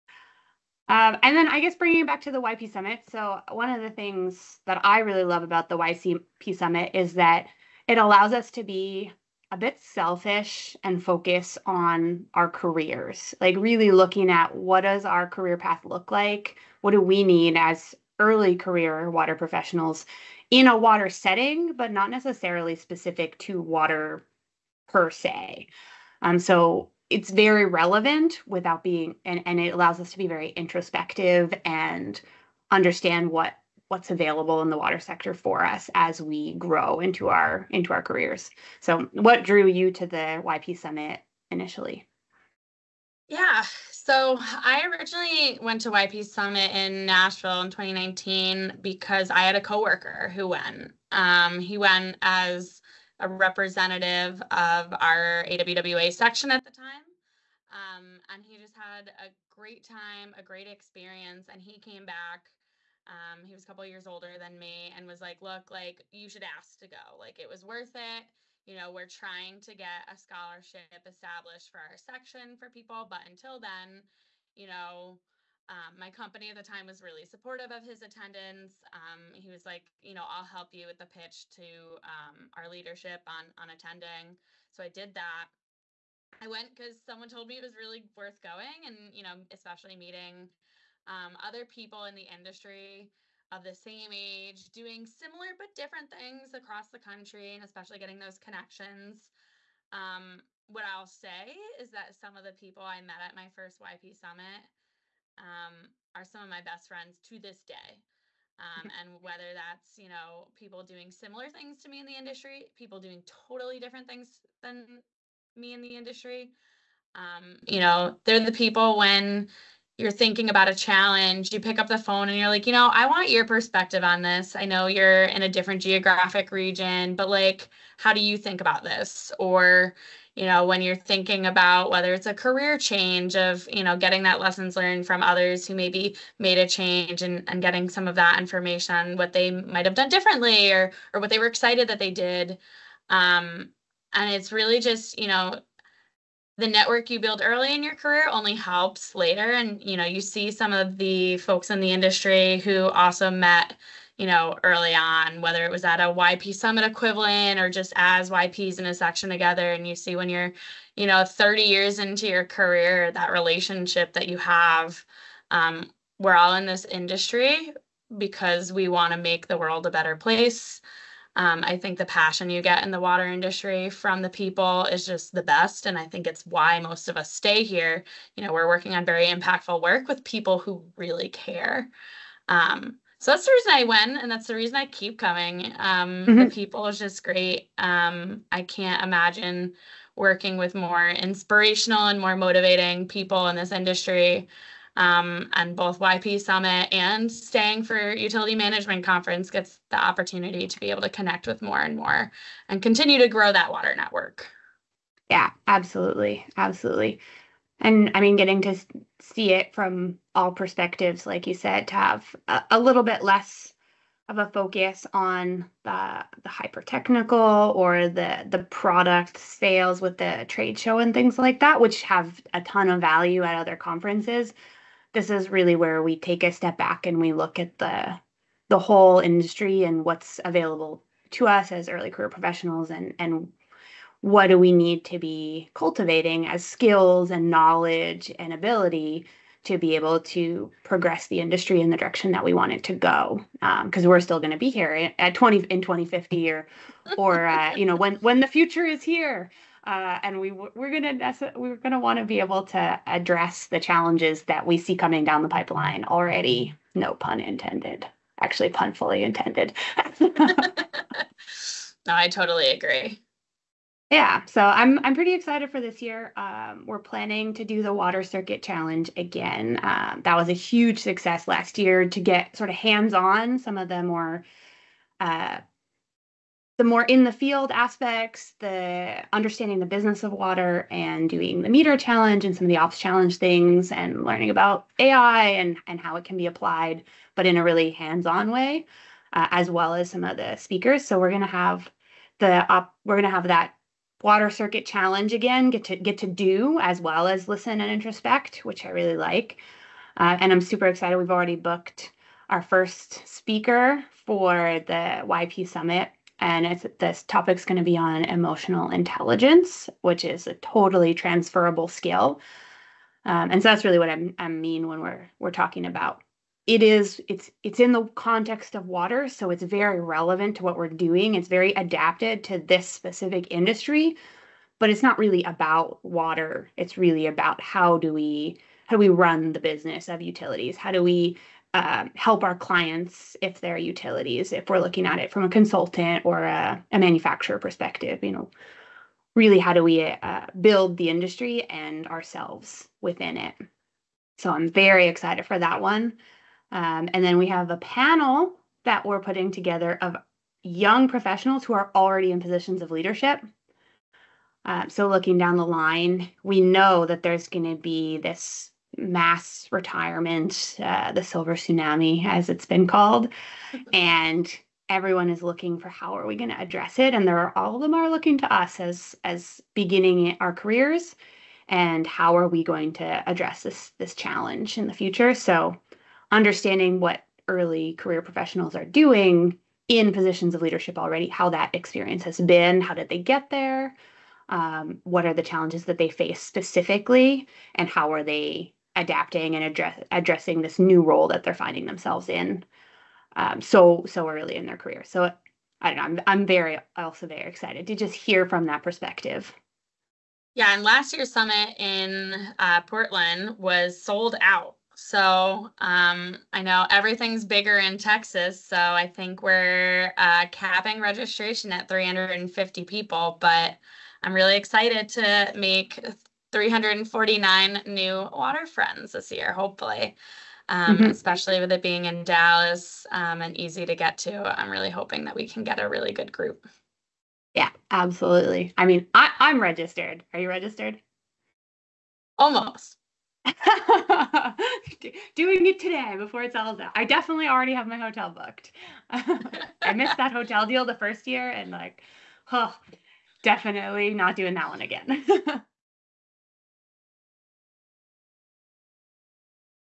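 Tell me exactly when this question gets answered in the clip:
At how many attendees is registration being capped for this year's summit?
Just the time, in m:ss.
6:51.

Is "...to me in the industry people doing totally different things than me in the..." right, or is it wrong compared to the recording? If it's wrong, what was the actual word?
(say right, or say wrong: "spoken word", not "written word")
right.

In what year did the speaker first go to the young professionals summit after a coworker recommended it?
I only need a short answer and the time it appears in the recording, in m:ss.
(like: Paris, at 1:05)
2019, at 0:47.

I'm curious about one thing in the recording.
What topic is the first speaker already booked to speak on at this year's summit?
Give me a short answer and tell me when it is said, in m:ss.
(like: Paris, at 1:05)
emotional intelligence, at 5:08.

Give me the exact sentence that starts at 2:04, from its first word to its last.
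I know you're in a different geographic region, but like, how do you think about this?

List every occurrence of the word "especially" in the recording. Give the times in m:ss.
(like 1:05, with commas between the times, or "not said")
1:29, 1:37, 7:01.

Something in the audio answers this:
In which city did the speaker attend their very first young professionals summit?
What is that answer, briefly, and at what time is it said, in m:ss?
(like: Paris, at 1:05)
Nashville, at 0:47.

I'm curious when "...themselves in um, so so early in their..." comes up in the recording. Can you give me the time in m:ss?
6:31.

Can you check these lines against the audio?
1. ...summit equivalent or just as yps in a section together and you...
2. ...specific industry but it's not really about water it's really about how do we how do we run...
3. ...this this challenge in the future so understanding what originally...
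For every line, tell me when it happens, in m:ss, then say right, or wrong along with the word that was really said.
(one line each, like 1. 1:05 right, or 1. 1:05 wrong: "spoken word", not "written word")
1. 2:36 right
2. 5:22 right
3. 6:13 wrong: "early", not "originally".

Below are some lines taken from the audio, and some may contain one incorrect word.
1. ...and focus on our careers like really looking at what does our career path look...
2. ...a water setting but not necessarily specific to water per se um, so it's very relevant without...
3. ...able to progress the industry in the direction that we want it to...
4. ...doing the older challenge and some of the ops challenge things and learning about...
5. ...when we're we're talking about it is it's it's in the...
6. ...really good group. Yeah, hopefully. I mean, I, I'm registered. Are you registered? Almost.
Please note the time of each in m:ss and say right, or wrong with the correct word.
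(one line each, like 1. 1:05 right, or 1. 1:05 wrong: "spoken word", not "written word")
1. 0:10 right
2. 0:20 right
3. 3:59 right
4. 4:41 wrong: "meter", not "older"
5. 5:14 right
6. 7:05 wrong: "absolutely", not "hopefully".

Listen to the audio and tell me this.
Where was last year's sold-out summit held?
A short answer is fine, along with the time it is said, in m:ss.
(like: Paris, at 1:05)
Portland, at 6:42.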